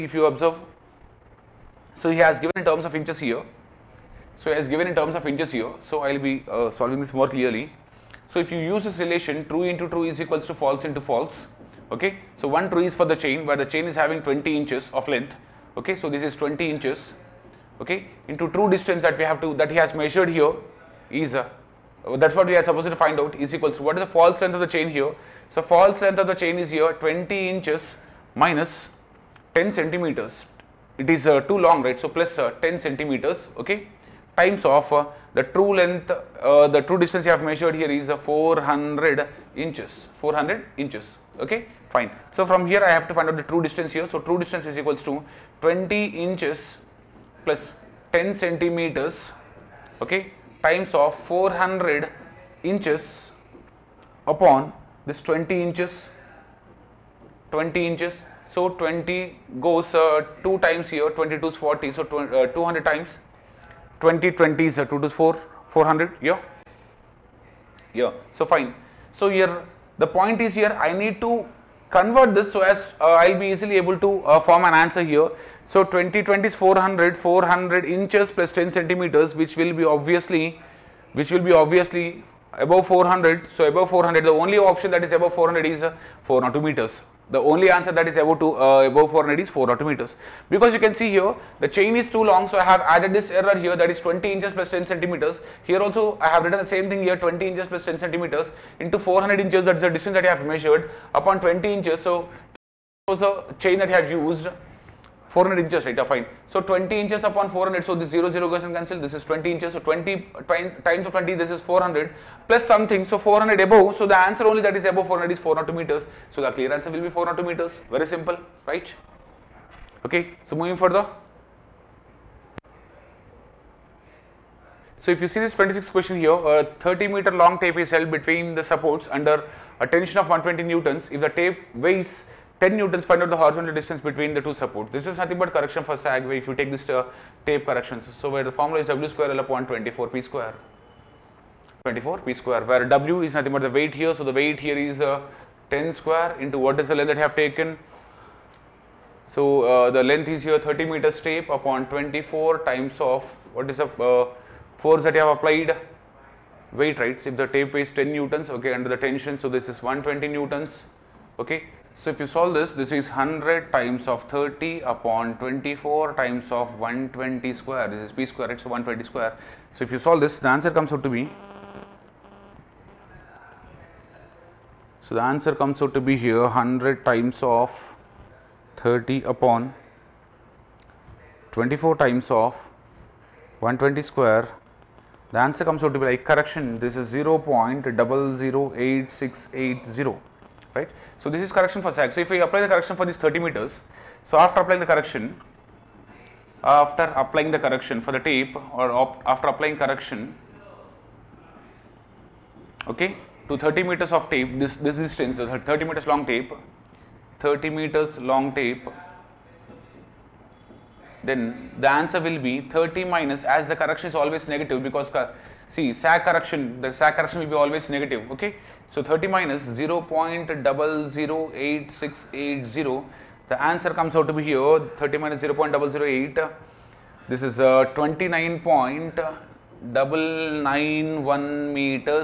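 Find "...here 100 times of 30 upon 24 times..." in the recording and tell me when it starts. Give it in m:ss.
2:56.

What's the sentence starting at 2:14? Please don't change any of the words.
This is nothing but correction for sag where if you take this uh, tape corrections.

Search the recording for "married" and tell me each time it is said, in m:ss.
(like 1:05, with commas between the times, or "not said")
not said.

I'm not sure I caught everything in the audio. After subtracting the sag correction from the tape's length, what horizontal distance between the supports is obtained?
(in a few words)
29.991 meters.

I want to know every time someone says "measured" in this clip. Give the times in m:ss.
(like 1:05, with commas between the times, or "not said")
0:19, 0:37, 1:40.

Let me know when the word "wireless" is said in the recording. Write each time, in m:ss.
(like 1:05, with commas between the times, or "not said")
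not said.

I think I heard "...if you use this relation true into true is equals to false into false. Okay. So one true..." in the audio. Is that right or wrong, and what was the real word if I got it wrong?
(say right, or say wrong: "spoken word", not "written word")
right.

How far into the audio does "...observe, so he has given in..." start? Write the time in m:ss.
0:00.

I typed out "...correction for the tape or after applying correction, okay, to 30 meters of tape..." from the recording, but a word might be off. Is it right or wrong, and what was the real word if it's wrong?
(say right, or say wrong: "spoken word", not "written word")
right.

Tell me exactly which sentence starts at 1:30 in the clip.
Because you can see here, the chain is too long.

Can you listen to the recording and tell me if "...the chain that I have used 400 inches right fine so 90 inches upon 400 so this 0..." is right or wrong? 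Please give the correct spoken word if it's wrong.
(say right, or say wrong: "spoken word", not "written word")
wrong: "20", not "90".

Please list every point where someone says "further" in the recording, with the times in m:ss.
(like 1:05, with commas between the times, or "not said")
2:00.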